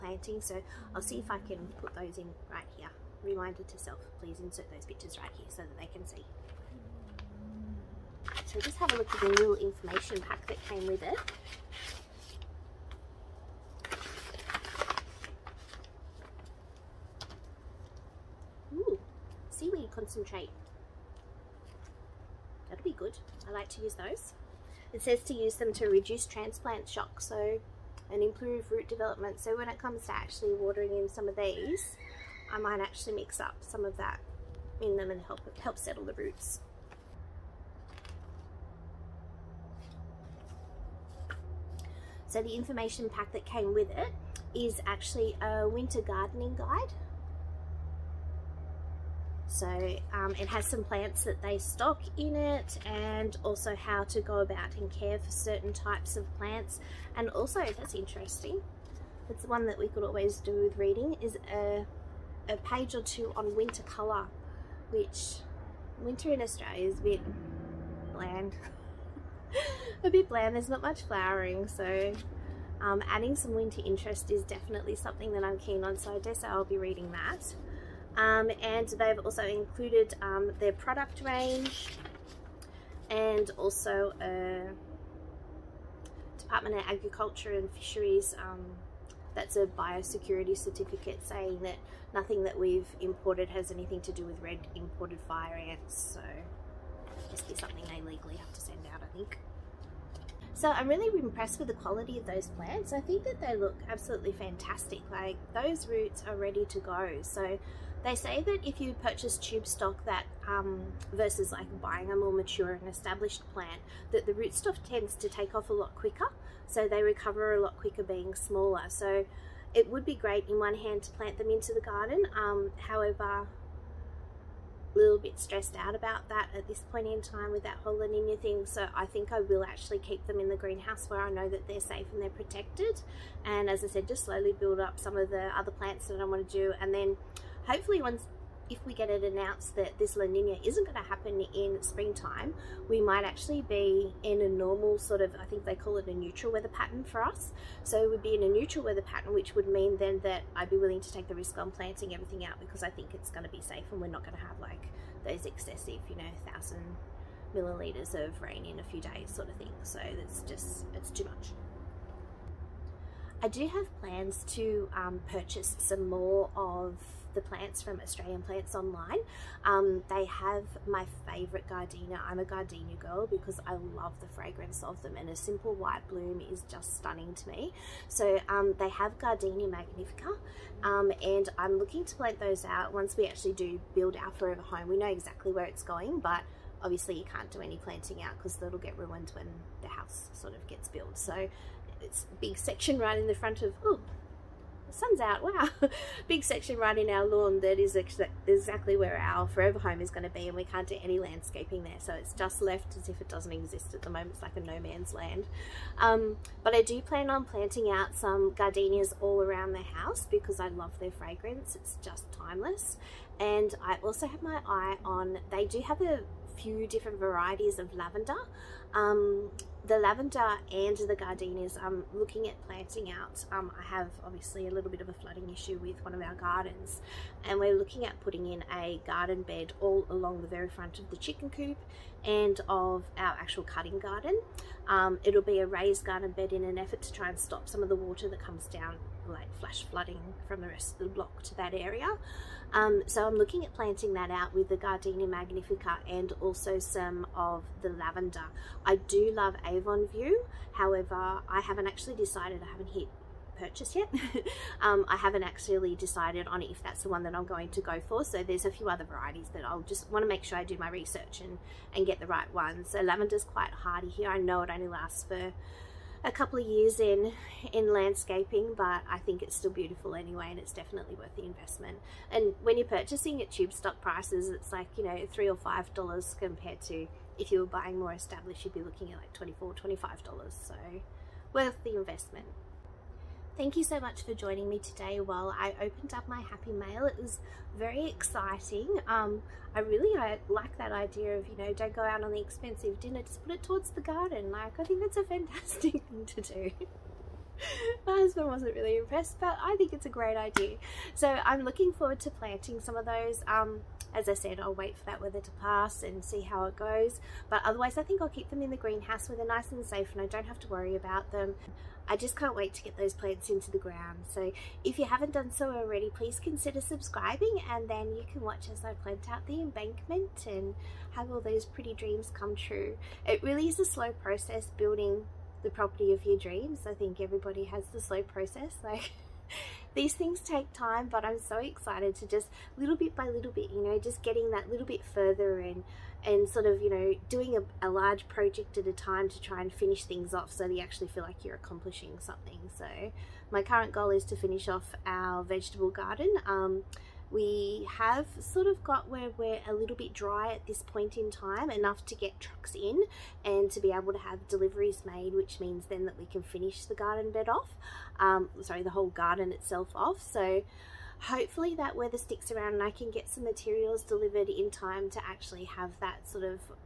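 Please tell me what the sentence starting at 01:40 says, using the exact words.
So I'm really impressed with the quality of those plants.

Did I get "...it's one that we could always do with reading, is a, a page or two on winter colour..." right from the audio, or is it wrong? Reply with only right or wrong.
right.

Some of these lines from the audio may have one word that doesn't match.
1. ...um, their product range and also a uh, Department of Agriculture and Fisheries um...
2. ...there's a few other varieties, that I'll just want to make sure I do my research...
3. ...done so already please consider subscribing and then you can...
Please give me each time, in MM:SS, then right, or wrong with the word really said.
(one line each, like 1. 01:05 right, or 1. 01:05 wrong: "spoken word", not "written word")
1. 01:20 right
2. 04:18 right
3. 05:15 right.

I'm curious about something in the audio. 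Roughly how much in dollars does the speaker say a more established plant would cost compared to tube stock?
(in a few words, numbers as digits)
24 to 25 dollars.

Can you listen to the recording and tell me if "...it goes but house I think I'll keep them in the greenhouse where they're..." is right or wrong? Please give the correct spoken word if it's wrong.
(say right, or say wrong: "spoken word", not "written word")
wrong: "otherwise", not "house".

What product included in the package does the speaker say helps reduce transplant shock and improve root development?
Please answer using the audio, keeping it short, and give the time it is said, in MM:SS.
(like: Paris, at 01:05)
Seaweed concentrate, at 00:19.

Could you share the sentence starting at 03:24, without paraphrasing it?
It's like a no man's land.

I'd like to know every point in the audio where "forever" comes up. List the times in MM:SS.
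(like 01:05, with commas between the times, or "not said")
03:04, 03:19.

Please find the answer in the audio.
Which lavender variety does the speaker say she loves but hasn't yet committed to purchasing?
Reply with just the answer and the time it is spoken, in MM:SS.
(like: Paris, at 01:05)
Avon View, at 04:09.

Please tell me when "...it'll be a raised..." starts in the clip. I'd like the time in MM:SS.
03:55.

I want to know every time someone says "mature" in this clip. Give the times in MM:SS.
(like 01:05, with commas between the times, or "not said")
01:52.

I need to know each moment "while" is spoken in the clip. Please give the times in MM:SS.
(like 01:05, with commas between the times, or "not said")
04:45.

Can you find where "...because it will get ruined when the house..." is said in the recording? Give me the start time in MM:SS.
03:08.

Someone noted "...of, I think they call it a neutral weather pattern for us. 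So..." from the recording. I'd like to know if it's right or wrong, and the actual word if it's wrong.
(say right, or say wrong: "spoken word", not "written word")
right.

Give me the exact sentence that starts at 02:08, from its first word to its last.
So I think I will actually keep them in the greenhouse where I know that they're safe and they're protected.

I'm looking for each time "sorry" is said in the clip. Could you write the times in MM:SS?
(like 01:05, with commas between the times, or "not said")
05:58.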